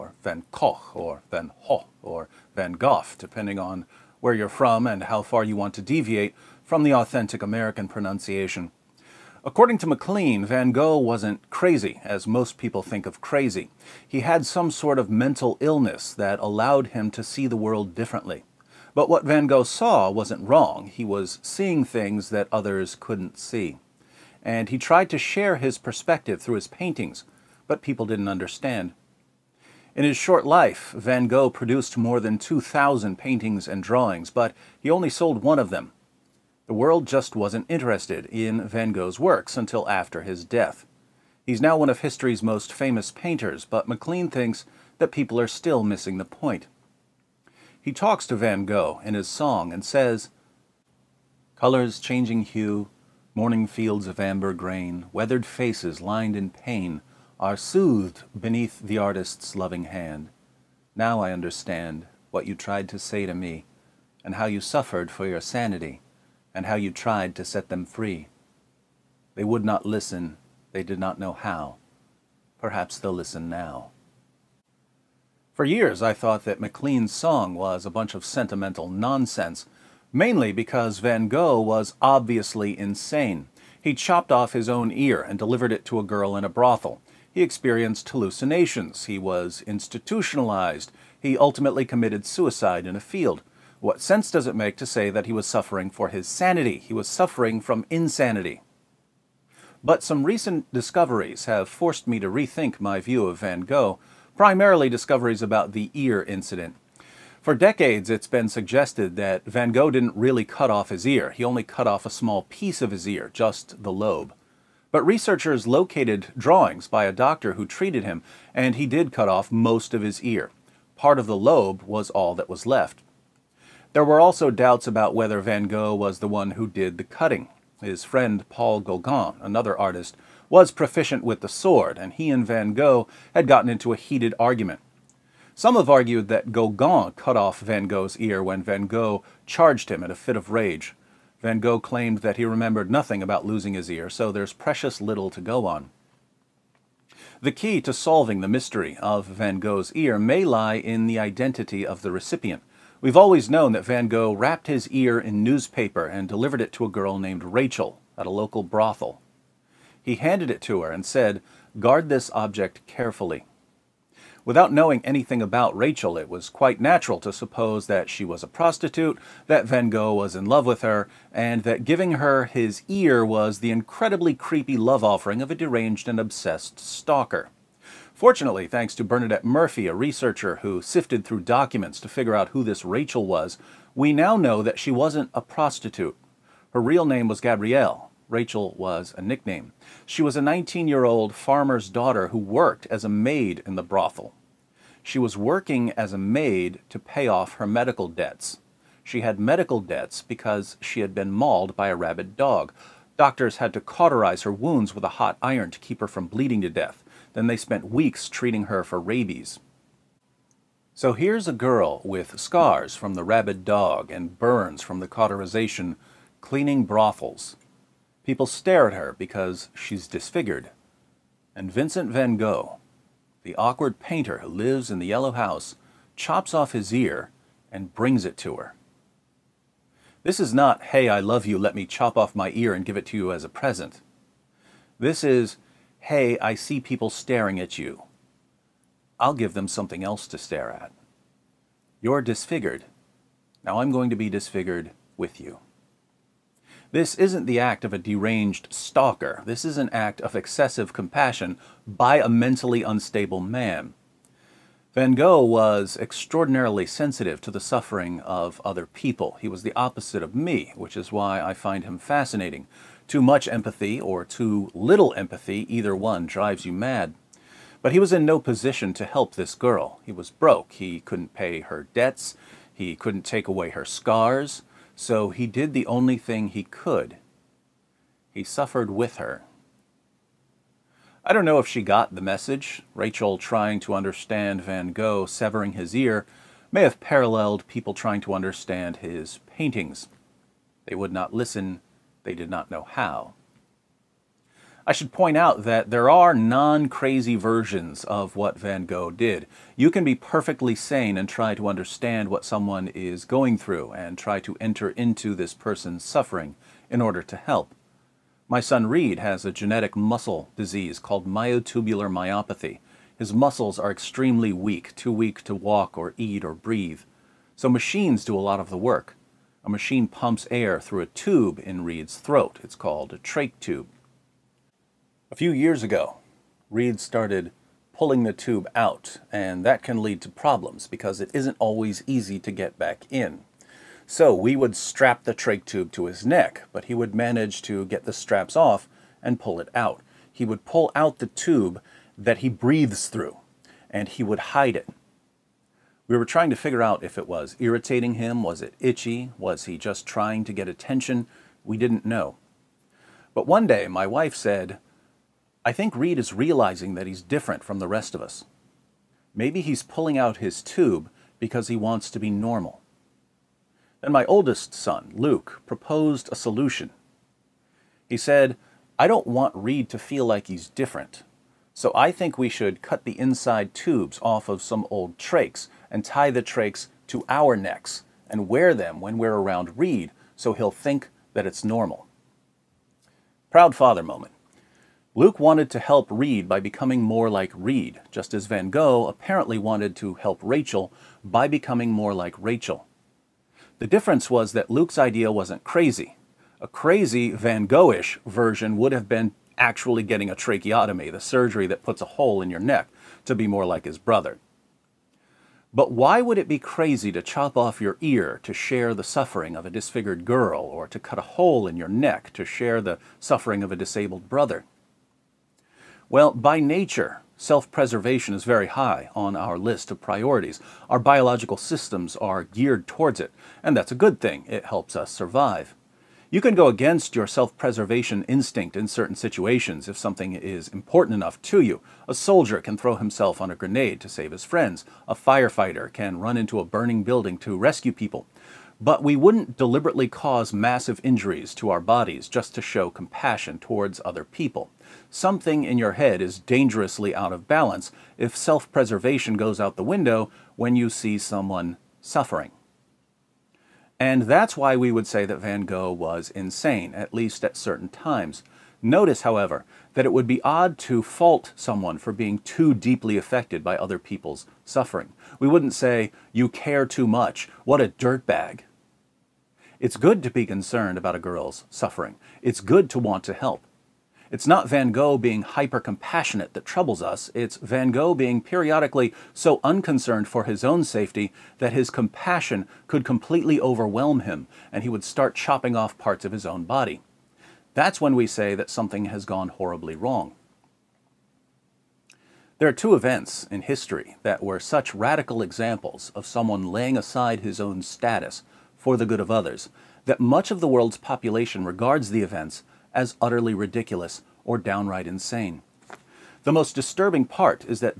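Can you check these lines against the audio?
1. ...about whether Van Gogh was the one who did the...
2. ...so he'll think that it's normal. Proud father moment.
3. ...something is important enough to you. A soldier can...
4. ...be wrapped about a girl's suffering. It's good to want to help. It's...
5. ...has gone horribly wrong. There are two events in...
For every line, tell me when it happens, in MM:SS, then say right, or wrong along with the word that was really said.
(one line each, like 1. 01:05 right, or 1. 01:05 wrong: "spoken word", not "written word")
1. 02:04 right
2. 06:20 right
3. 07:09 right
4. 07:50 wrong: "concerned", not "wrapped"
5. 08:09 right.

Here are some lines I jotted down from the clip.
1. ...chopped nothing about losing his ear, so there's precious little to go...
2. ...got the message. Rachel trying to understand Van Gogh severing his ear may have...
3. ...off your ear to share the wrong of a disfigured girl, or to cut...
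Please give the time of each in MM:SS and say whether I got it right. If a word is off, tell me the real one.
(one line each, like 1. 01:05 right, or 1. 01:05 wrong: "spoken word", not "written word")
1. 02:22 wrong: "remembered", not "chopped"
2. 04:41 right
3. 06:47 wrong: "suffering", not "wrong".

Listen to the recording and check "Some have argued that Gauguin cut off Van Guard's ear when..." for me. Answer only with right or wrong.
wrong.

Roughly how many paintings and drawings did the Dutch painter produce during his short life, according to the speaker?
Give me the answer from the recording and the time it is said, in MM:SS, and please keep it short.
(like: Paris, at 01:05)
More than 2,000, at 00:32.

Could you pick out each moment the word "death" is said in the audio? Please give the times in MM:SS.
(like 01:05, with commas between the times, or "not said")
00:40, 03:26.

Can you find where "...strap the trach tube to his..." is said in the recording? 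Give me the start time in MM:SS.
05:34.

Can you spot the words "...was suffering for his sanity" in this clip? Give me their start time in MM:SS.
01:35.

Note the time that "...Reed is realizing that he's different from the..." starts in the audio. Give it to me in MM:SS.
05:55.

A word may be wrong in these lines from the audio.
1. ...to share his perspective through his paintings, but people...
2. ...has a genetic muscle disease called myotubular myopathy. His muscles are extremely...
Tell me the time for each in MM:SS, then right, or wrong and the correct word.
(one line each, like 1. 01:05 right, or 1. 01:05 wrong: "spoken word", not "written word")
1. 00:25 right
2. 05:09 right.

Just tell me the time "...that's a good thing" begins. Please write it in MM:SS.
07:03.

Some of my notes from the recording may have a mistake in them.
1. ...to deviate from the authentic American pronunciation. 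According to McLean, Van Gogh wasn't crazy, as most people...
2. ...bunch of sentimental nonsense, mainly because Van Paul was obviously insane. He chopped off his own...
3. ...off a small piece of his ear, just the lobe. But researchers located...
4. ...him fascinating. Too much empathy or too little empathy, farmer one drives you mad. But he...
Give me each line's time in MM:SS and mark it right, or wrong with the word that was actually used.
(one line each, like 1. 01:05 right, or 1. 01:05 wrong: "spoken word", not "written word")
1. 00:05 right
2. 01:17 wrong: "Gogh", not "Paul"
3. 01:51 right
4. 04:21 wrong: "either", not "farmer".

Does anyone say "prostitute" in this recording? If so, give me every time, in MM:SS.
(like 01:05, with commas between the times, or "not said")
02:48, 03:05.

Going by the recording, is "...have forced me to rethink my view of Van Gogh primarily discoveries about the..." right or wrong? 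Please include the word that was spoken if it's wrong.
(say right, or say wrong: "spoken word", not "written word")
right.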